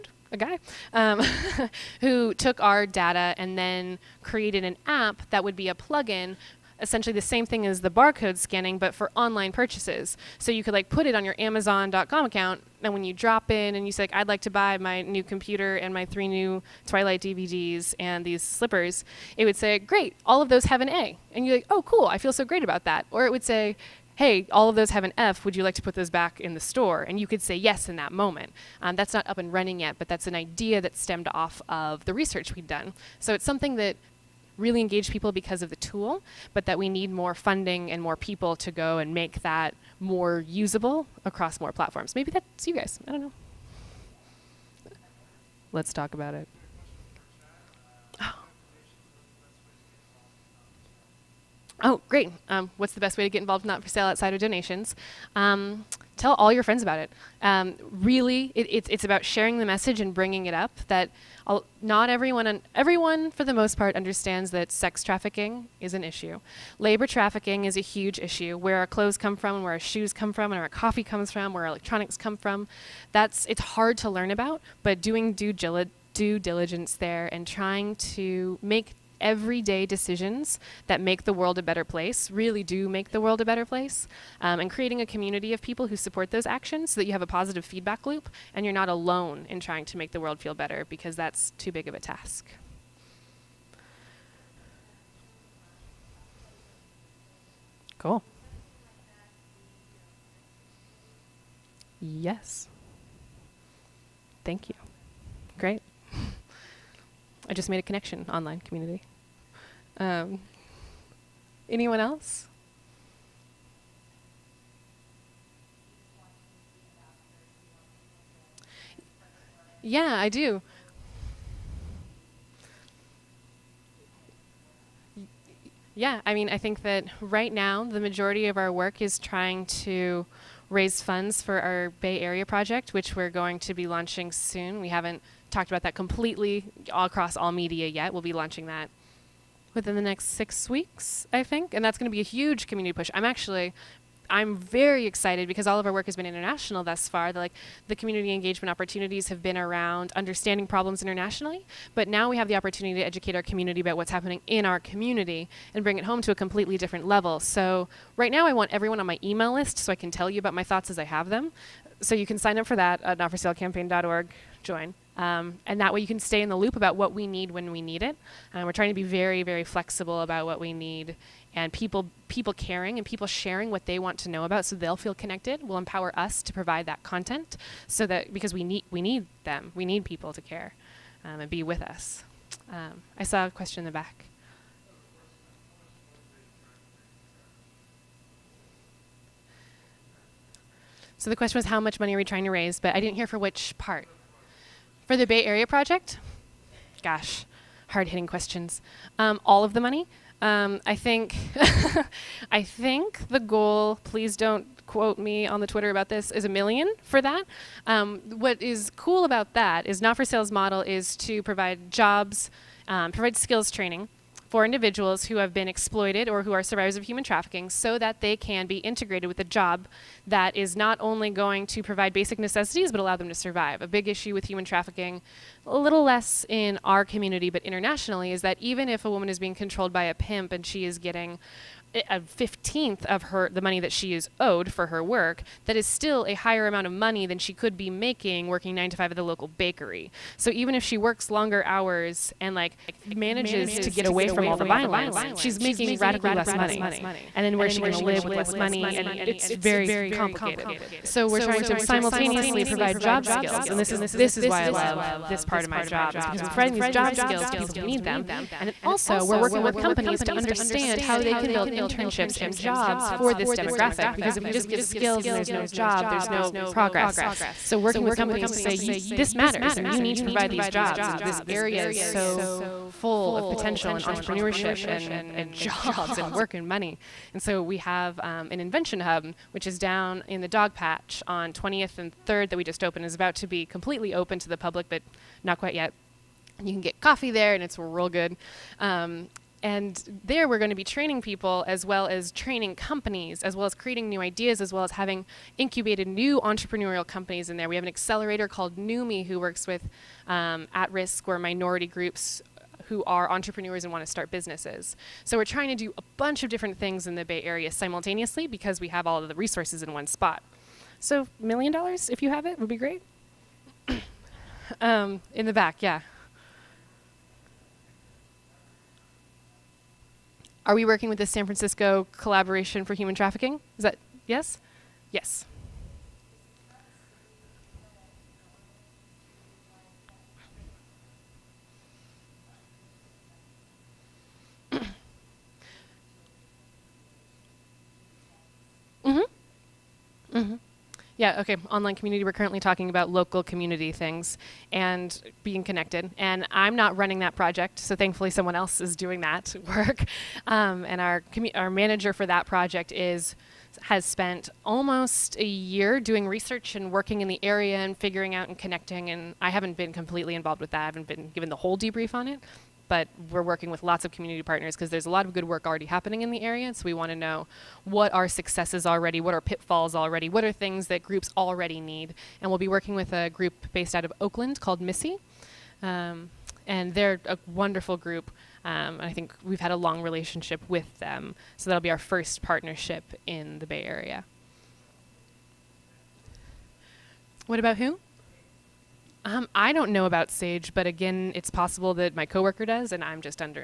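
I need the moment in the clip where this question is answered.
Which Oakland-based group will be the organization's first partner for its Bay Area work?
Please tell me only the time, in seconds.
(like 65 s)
374 s.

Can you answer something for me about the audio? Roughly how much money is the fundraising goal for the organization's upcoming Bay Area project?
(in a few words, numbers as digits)
a million.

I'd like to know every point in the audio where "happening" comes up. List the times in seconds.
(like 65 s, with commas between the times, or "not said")
154 s, 365 s.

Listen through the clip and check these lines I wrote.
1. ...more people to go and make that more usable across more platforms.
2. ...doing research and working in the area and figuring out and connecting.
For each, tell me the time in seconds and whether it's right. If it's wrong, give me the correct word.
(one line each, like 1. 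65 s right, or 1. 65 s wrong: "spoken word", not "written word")
1. 38 s right
2. 355 s right.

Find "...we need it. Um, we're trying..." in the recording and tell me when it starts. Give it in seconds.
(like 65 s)
167 s.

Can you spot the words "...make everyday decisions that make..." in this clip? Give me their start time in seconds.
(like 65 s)
78 s.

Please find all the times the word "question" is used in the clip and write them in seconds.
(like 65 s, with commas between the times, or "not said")
183 s, 191 s, 198 s.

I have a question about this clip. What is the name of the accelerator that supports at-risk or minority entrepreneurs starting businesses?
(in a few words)
NUMI.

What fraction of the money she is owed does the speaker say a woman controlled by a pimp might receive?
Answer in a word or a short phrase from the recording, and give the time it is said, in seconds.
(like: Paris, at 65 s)
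a 15th, at 232 s.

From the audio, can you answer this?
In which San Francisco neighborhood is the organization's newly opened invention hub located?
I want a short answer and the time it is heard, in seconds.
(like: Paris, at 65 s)
Dogpatch, at 280 s.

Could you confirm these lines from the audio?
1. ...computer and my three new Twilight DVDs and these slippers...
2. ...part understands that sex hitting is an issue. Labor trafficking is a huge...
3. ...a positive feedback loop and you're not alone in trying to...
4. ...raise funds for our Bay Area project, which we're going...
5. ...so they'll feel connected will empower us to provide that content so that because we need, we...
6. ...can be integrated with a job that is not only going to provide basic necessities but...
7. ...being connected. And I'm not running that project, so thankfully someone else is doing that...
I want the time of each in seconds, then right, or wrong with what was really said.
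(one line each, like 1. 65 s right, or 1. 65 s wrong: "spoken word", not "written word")
1. 15 s right
2. 63 s wrong: "trafficking", not "hitting"
3. 87 s right
4. 130 s right
5. 174 s right
6. 218 s right
7. 345 s right.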